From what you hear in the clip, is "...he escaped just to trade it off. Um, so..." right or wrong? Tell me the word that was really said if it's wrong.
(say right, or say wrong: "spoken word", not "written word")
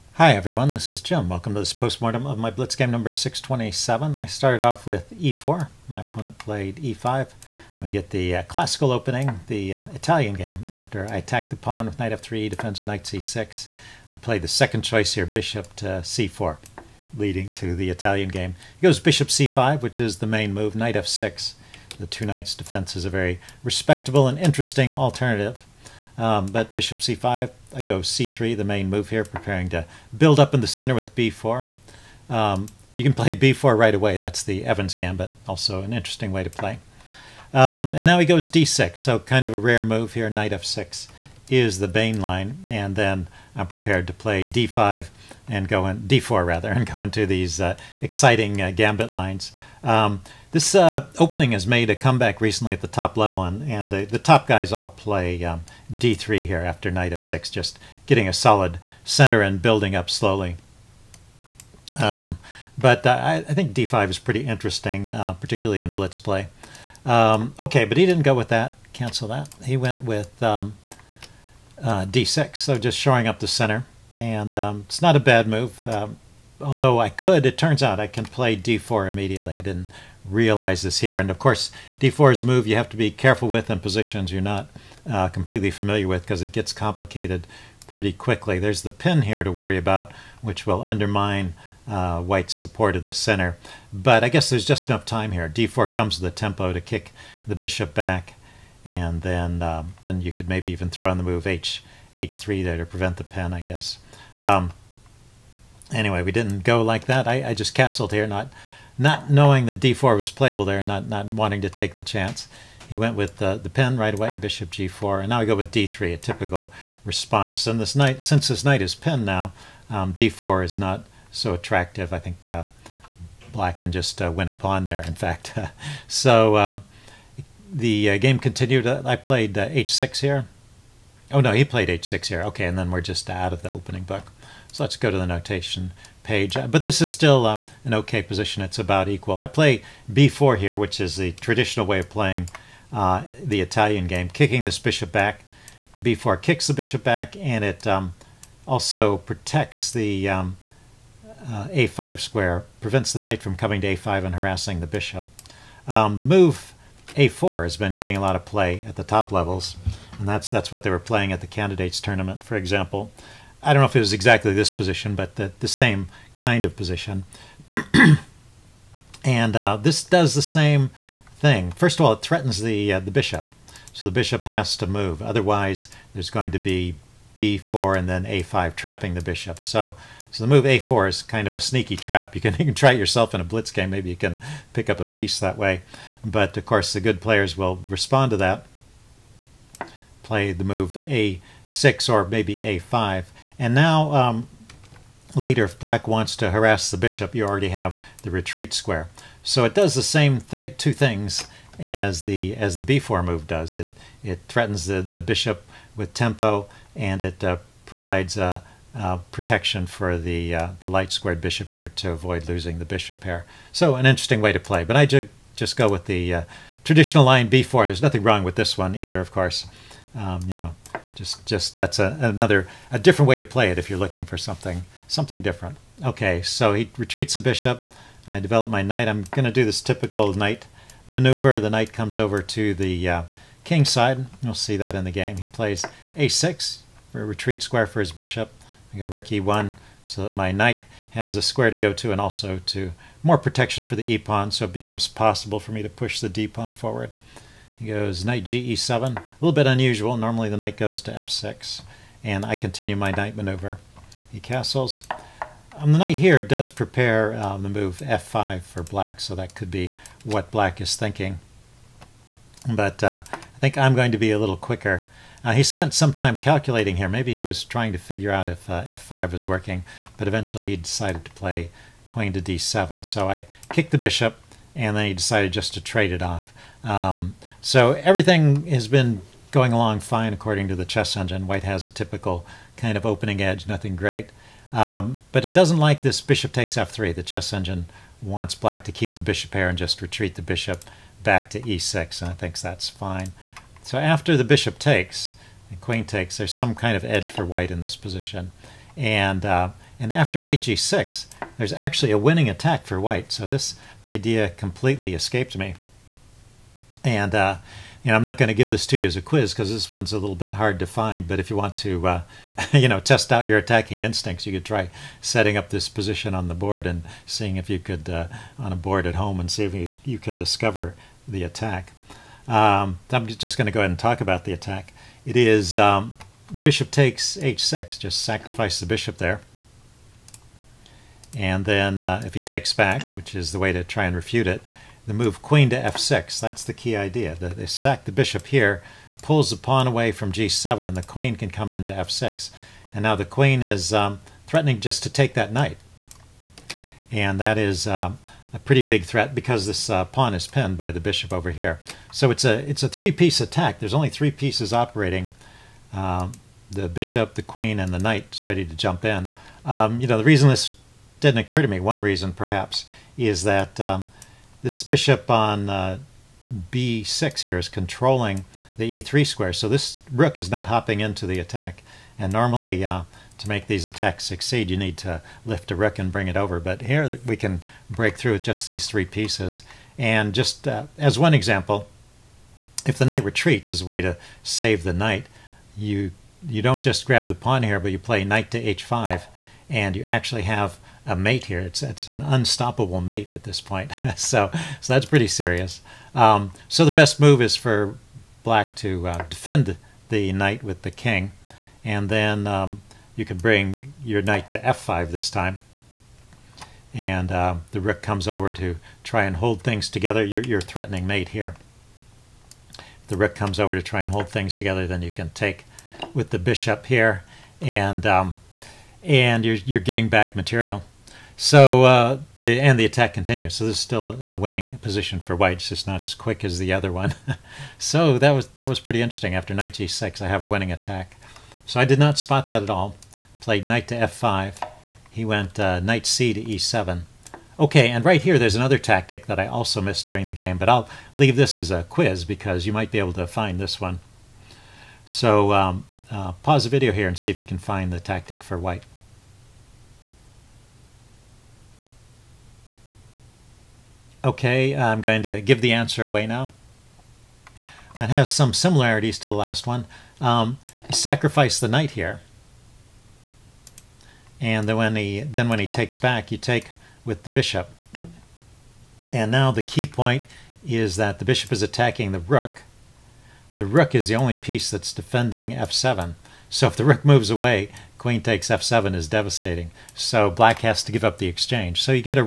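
wrong: "decided", not "escaped".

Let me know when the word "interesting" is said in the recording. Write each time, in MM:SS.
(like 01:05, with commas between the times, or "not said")
00:24, 00:35, 01:04, 03:34, 07:09.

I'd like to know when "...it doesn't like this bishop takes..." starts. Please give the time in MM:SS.
04:45.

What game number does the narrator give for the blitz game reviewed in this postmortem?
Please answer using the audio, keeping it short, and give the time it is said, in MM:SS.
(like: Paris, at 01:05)
627, at 00:03.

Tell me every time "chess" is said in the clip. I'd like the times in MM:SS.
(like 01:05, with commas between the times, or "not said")
04:40, 04:47.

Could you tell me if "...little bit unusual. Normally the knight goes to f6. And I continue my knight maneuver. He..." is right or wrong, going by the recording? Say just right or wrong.
right.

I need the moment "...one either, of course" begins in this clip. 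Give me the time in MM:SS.
03:38.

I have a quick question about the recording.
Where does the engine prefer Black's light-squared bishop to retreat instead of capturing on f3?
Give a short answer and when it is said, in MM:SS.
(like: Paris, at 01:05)
e6, at 04:51.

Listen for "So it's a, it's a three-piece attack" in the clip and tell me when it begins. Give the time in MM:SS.
05:52.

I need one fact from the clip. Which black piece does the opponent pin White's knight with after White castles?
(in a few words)
bishop g4.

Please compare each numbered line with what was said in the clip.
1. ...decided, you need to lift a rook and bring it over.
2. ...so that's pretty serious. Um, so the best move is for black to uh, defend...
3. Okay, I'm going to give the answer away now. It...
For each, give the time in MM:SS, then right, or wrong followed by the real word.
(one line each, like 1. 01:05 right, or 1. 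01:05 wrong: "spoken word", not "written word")
1. 06:14 wrong: "succeed", not "decided"
2. 06:34 right
3. 07:34 right.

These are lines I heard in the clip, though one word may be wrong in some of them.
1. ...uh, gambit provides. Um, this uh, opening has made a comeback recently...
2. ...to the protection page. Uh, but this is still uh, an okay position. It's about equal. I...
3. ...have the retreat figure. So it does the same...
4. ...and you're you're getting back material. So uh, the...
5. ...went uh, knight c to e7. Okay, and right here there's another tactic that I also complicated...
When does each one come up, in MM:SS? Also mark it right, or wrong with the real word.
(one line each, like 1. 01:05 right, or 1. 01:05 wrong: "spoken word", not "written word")
1. 00:48 wrong: "lines", not "provides"
2. 02:15 wrong: "notation", not "protection"
3. 03:17 wrong: "square", not "figure"
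4. 06:59 right
5. 07:15 wrong: "missed", not "complicated".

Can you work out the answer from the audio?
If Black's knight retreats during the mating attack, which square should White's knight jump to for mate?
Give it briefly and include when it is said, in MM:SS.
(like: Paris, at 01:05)
h5, at 06:28.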